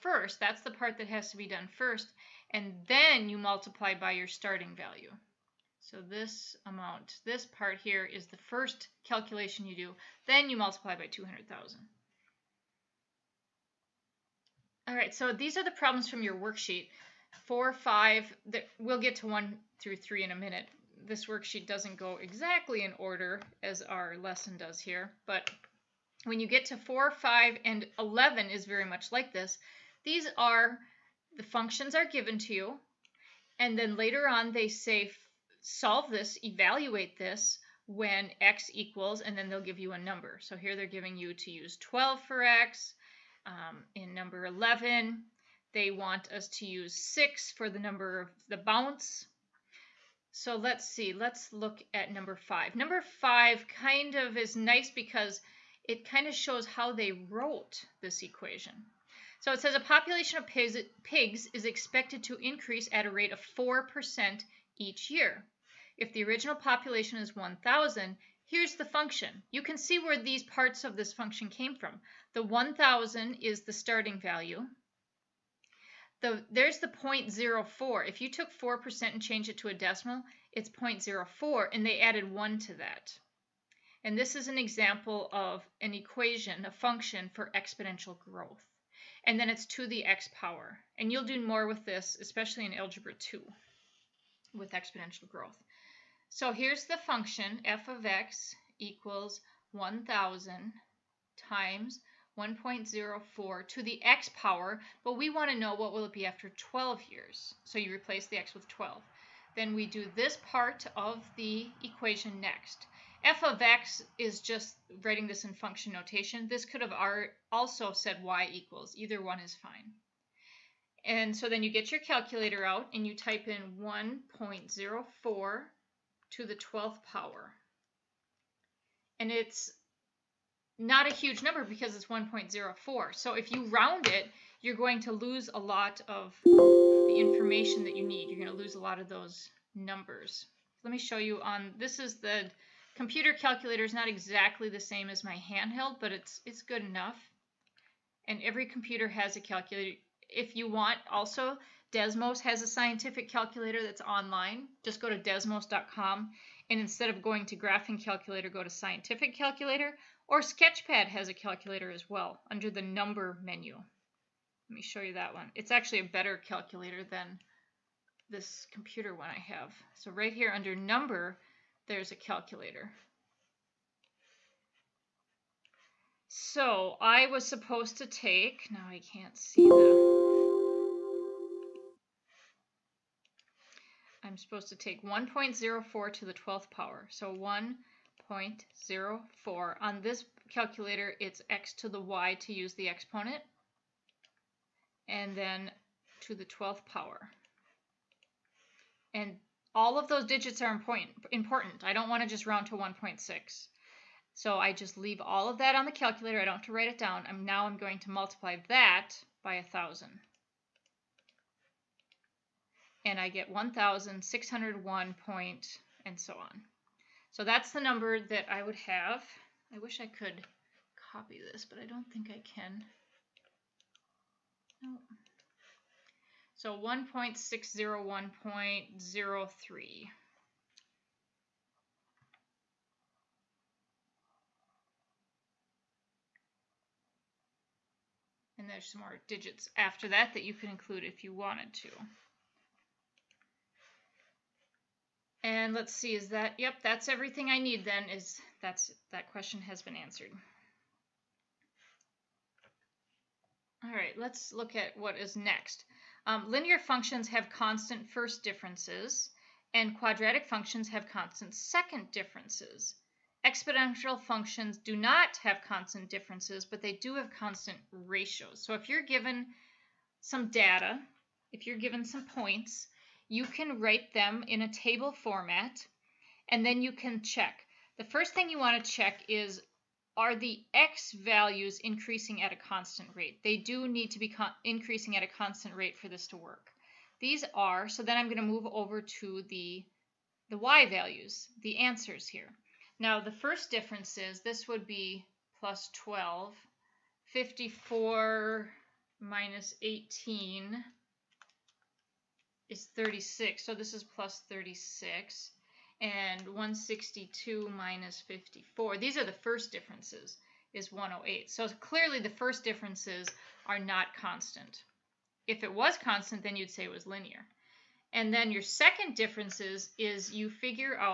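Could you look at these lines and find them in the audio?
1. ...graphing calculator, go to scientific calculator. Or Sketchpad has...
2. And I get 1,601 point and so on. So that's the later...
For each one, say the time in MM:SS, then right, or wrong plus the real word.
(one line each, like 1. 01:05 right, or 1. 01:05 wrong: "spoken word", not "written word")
1. 02:37 right
2. 03:33 wrong: "number", not "later".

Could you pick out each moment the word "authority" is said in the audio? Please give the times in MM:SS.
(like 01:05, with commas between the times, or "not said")
not said.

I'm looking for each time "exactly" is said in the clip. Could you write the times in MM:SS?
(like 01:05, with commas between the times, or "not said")
00:22, 02:24.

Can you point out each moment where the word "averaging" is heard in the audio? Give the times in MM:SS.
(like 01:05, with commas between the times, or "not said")
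not said.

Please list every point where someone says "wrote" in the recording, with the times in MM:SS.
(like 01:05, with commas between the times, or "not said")
00:57.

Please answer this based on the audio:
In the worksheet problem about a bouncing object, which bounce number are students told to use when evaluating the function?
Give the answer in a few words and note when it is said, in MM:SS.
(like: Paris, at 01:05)
6, at 00:46.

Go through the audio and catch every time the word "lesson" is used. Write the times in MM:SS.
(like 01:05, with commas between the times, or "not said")
00:24.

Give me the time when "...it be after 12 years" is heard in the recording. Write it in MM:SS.
01:46.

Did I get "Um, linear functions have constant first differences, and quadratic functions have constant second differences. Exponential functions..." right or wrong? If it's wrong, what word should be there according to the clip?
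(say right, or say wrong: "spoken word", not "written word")
right.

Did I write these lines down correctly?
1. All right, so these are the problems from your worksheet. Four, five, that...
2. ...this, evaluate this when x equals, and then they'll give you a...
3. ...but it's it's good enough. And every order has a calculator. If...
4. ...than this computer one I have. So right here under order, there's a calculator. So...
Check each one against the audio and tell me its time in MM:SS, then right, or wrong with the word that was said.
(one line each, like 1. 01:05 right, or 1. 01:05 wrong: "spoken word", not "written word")
1. 00:14 right
2. 00:36 right
3. 02:26 wrong: "computer", not "order"
4. 02:47 wrong: "number", not "order".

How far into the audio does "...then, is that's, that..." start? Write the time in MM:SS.
04:07.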